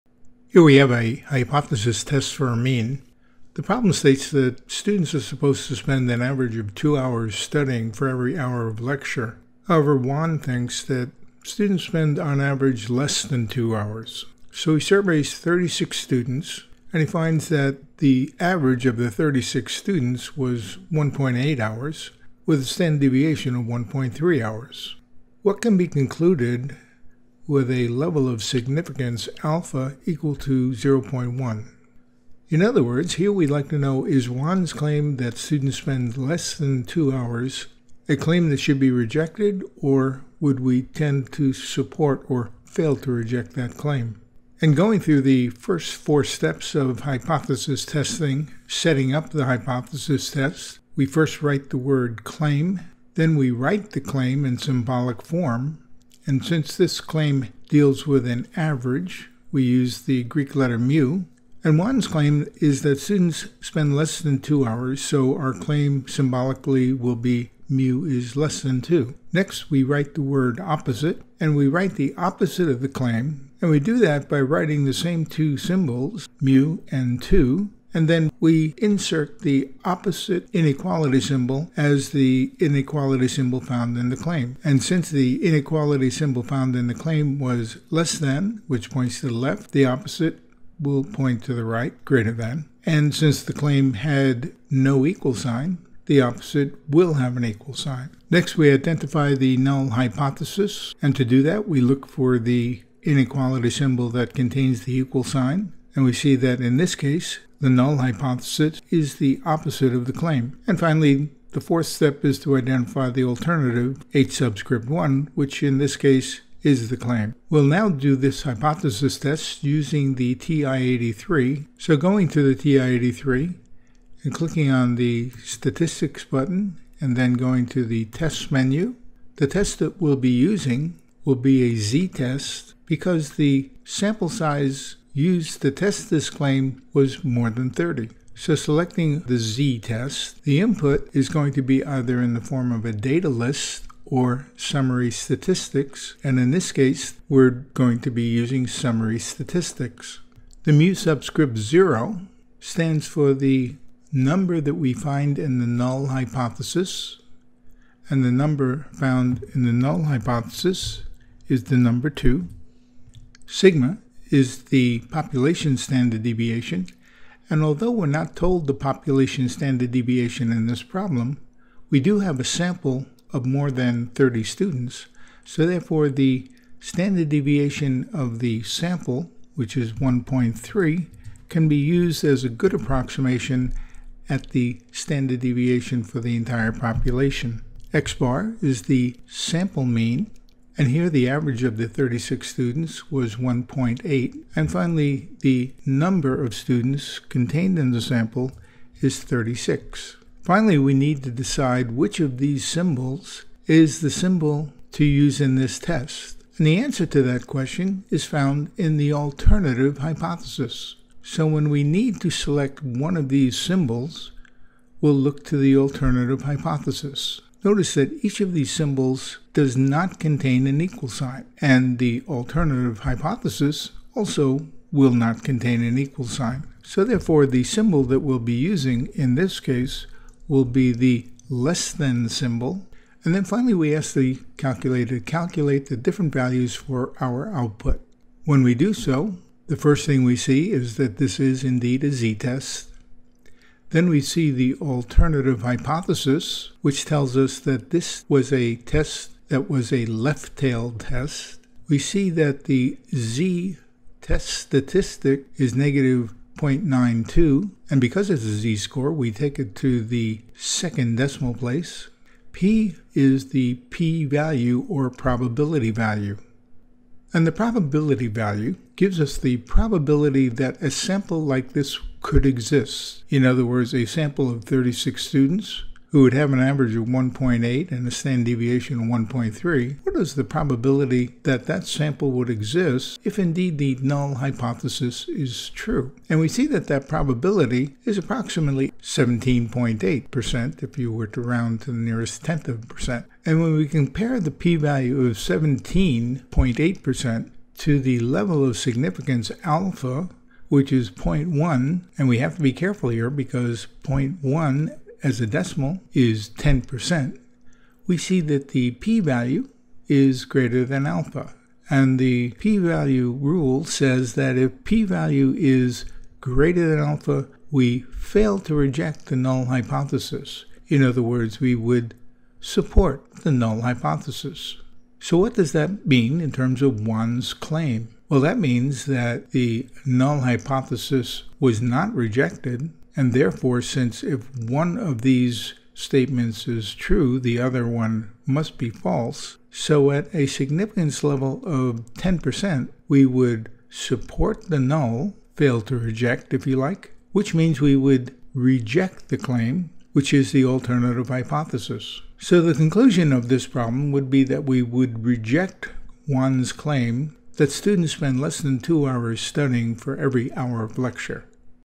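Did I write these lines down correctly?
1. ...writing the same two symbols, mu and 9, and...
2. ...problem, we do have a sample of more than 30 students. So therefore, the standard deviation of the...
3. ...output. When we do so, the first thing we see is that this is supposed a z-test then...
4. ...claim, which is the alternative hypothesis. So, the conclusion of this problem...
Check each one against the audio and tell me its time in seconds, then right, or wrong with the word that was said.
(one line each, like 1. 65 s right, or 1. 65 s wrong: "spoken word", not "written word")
1. 74 s wrong: "2", not "9"
2. 170 s right
3. 237 s wrong: "indeed", not "supposed"
4. 349 s right.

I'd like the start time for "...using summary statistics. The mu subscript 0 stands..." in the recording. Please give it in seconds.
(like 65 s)
148 s.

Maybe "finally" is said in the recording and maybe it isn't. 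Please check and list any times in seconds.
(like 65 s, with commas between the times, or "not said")
110 s, 194 s, 200 s, 233 s.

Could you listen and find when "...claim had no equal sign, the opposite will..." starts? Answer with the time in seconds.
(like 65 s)
93 s.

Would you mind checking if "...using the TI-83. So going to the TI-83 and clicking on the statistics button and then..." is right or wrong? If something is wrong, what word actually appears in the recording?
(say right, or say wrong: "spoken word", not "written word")
right.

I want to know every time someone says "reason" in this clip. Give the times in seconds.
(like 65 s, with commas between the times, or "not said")
not said.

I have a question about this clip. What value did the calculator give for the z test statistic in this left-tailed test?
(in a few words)
-0.92.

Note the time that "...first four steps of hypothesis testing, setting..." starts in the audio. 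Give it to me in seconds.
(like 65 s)
45 s.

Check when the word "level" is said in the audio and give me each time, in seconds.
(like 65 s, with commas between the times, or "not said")
27 s, 298 s, 341 s.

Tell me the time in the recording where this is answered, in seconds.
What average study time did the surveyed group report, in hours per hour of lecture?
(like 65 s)
20 s.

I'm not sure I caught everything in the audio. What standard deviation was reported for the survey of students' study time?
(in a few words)
1.3 hours.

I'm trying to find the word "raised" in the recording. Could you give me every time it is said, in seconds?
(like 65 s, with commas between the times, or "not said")
not said.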